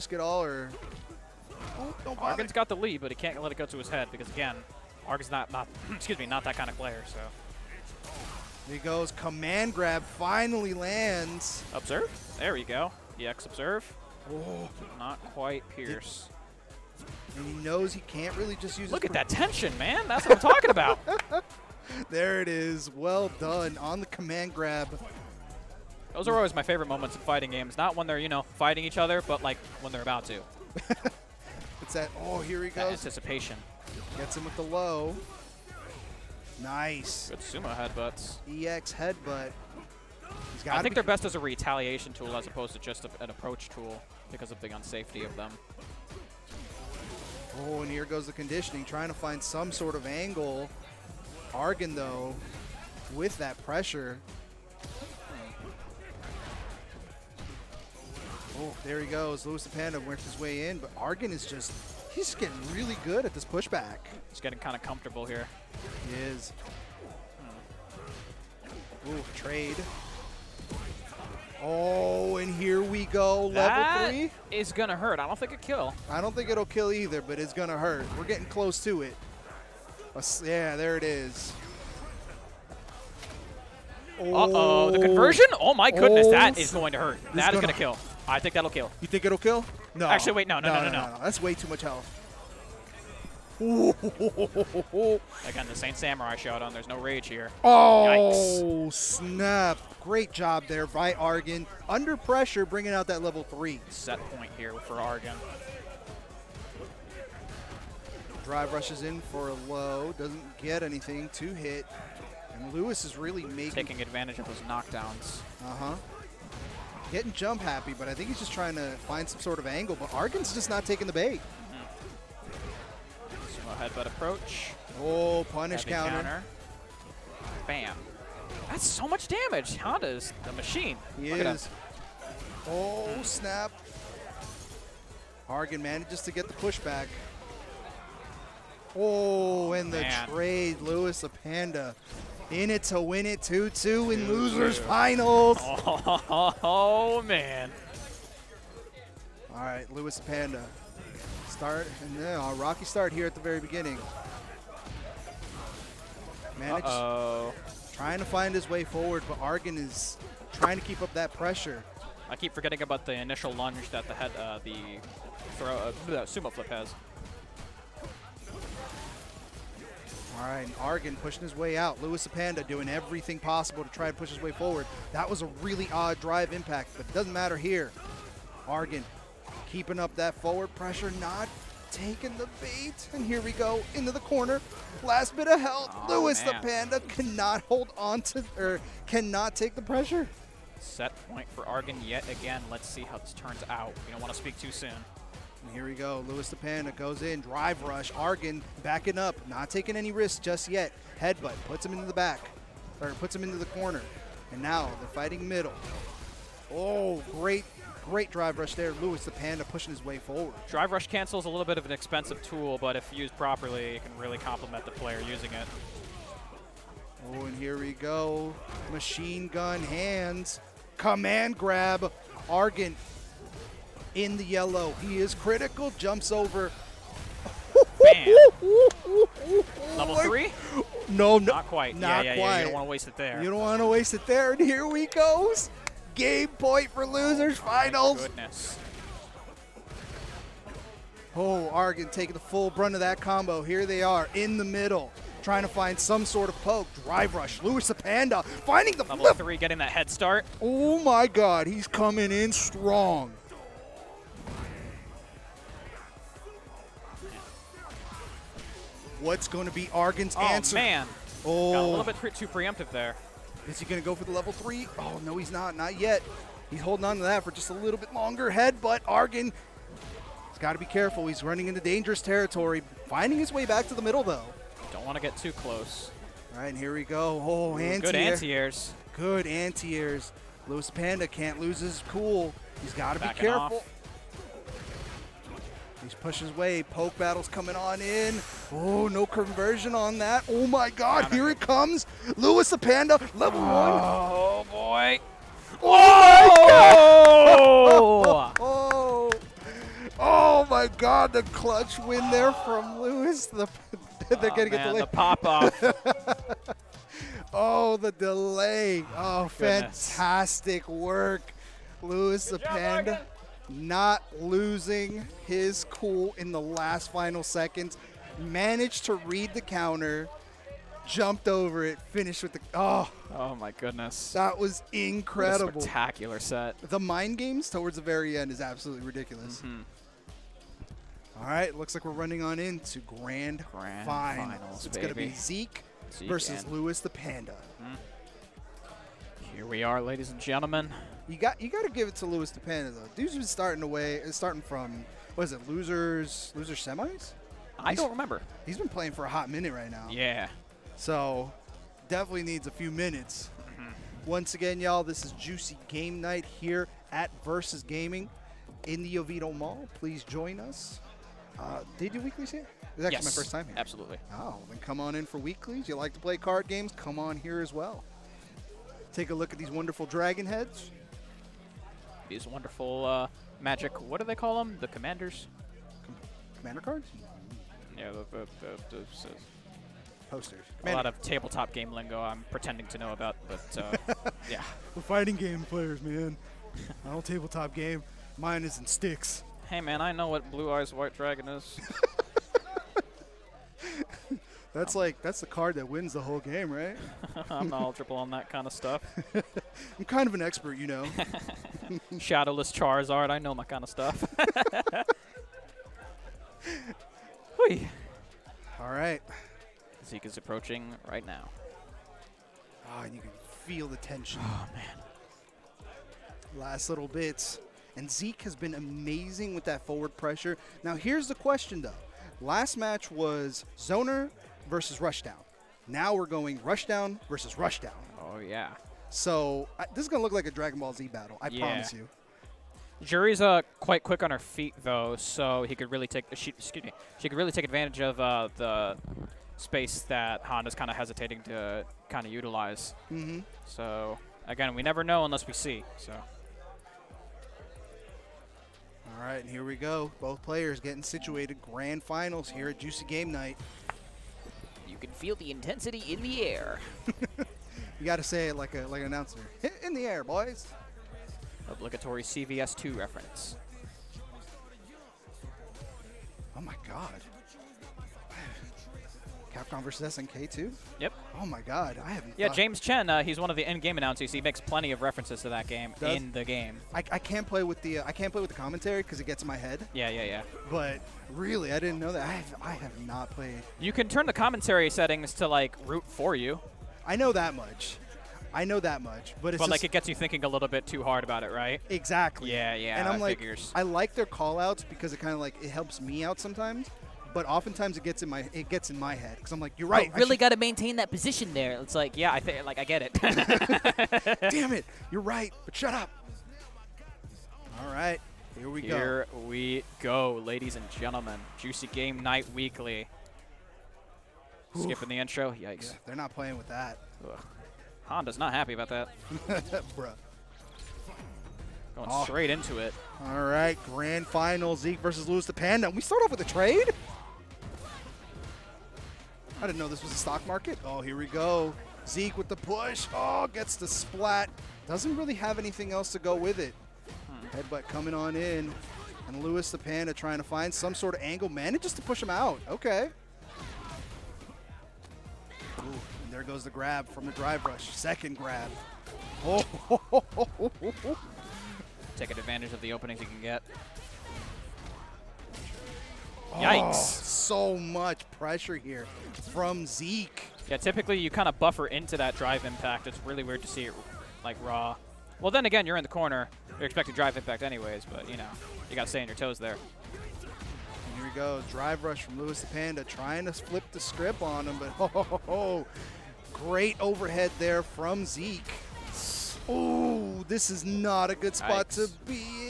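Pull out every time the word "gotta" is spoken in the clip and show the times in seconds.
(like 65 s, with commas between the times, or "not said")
not said.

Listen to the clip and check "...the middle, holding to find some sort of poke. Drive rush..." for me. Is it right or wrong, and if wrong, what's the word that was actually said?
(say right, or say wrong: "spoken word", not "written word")
wrong: "trying", not "holding".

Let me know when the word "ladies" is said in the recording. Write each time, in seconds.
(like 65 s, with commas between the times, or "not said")
340 s, 510 s.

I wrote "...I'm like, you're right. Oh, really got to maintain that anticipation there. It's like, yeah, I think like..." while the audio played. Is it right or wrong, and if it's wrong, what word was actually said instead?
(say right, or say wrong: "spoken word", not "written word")
wrong: "position", not "anticipation".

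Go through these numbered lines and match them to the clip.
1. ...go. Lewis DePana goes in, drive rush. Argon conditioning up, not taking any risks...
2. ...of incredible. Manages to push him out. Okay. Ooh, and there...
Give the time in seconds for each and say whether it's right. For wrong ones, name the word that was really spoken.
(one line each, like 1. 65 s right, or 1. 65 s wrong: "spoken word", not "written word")
1. 195 s wrong: "backing", not "conditioning"
2. 541 s wrong: "angle", not "incredible".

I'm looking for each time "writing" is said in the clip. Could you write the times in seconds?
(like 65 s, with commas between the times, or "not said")
not said.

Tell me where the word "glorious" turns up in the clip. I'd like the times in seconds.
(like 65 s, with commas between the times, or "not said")
not said.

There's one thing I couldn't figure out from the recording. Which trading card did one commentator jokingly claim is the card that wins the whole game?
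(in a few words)
Blue Eyes White Dragon.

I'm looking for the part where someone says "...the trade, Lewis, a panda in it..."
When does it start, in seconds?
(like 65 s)
139 s.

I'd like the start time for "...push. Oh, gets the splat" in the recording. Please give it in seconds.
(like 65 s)
532 s.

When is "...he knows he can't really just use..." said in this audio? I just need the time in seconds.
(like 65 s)
17 s.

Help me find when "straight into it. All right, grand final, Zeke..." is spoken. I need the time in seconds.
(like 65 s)
522 s.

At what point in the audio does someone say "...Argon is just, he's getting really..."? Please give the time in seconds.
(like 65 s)
60 s.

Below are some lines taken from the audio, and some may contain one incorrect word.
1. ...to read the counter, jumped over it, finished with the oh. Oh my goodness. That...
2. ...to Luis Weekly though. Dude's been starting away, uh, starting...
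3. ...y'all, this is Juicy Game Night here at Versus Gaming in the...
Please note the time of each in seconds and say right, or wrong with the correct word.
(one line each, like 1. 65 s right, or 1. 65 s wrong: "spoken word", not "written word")
1. 319 s right
2. 342 s wrong: "DePana", not "Weekly"
3. 354 s right.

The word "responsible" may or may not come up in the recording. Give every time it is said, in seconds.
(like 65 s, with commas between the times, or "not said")
not said.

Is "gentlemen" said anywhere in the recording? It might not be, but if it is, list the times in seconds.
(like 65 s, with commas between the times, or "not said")
340 s, 510 s.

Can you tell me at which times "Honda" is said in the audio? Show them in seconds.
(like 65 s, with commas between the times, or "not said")
129 s, 440 s, 518 s.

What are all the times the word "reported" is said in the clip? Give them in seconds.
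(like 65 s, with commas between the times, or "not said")
not said.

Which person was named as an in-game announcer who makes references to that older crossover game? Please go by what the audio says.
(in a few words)
James Chen.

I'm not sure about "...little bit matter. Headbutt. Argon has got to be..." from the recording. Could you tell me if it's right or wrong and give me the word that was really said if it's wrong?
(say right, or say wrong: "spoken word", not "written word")
wrong: "longer", not "matter".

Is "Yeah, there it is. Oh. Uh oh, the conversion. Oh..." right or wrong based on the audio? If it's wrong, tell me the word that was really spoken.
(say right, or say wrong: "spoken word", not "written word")
right.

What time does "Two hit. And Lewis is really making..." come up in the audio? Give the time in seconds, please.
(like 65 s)
111 s.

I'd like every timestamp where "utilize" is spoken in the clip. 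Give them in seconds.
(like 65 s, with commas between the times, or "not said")
442 s.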